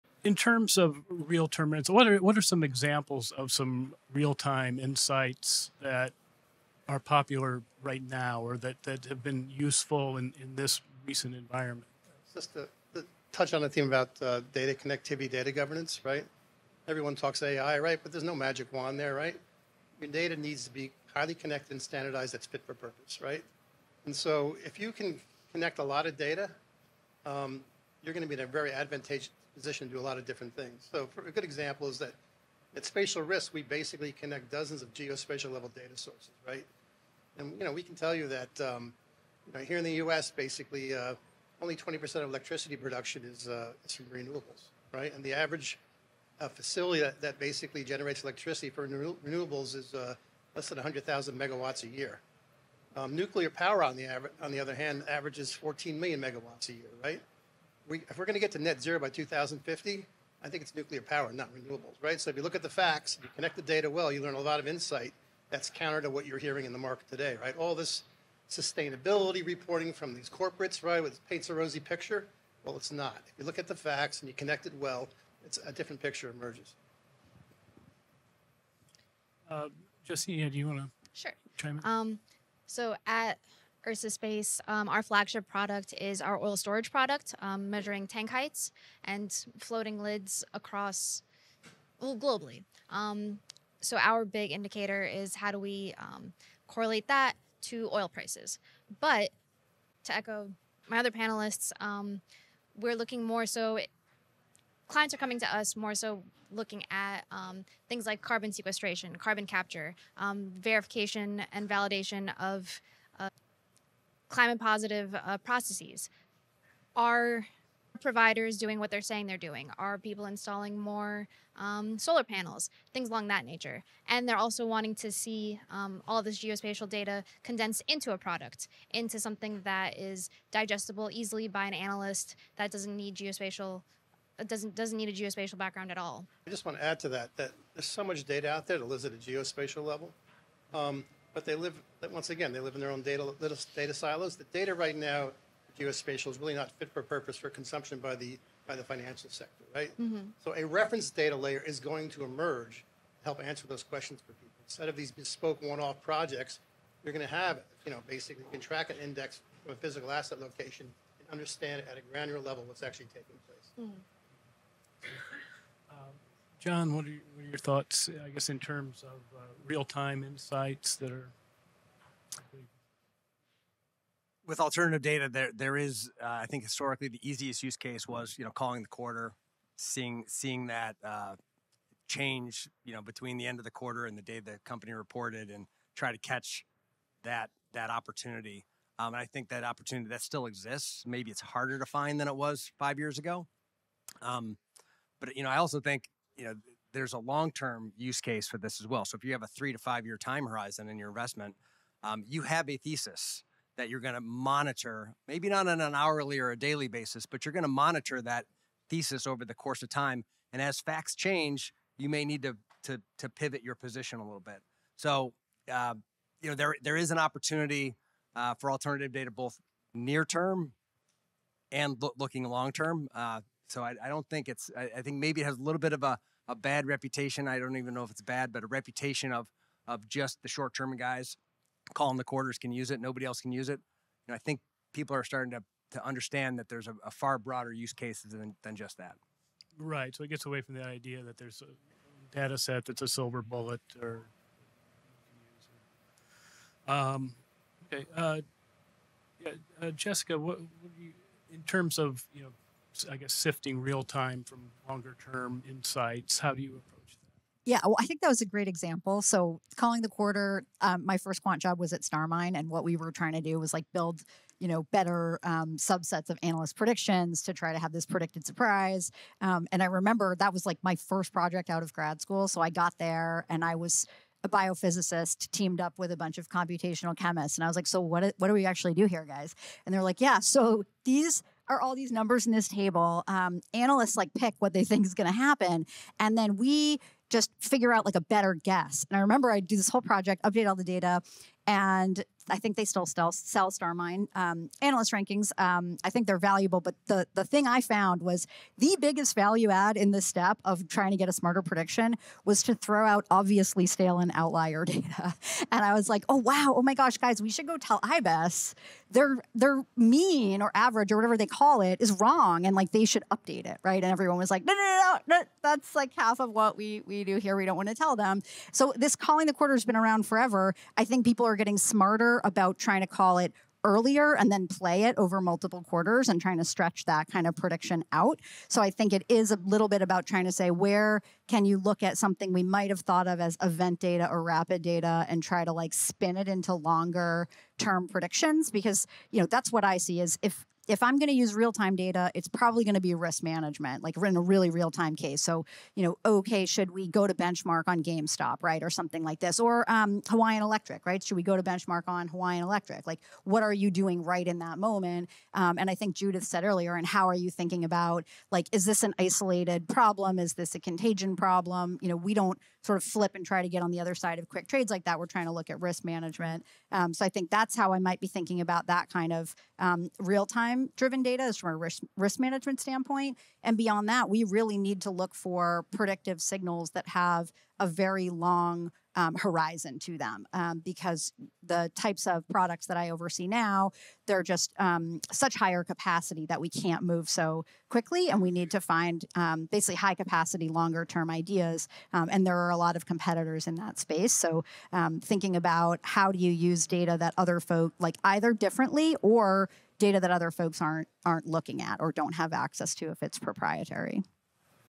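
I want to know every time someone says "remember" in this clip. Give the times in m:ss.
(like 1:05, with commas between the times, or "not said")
4:29, 4:49.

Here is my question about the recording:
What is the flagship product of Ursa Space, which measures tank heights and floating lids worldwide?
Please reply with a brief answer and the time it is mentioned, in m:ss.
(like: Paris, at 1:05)
oil storage product, at 1:26.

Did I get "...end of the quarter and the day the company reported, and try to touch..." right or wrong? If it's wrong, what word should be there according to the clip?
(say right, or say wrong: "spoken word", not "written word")
wrong: "catch", not "touch".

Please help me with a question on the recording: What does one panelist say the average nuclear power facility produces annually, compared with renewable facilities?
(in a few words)
14 million megawatts.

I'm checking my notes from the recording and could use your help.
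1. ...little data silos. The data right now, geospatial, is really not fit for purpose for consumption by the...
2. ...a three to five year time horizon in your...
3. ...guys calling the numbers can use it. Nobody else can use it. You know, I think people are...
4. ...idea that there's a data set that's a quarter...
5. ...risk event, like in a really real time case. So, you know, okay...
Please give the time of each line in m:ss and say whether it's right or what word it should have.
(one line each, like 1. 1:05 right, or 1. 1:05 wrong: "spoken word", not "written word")
1. 2:23 right
2. 3:19 right
3. 3:50 wrong: "quarters", not "numbers"
4. 4:00 wrong: "silver", not "quarter"
5. 5:43 wrong: "management", not "event".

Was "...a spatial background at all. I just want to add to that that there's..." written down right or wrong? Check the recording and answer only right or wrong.
wrong.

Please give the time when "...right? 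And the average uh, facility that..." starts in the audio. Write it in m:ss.
0:44.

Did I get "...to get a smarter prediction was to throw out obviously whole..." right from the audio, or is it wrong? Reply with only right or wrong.
wrong.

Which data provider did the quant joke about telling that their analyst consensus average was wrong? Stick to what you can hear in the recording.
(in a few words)
IBES.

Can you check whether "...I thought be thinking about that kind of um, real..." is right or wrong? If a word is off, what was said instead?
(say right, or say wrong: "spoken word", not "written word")
wrong: "might", not "thought".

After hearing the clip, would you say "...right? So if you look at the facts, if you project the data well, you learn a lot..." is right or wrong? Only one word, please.
wrong.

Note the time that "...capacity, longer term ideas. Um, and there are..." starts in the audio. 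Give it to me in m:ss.
6:30.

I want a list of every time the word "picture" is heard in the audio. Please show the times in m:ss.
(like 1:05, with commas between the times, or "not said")
1:11, 1:16.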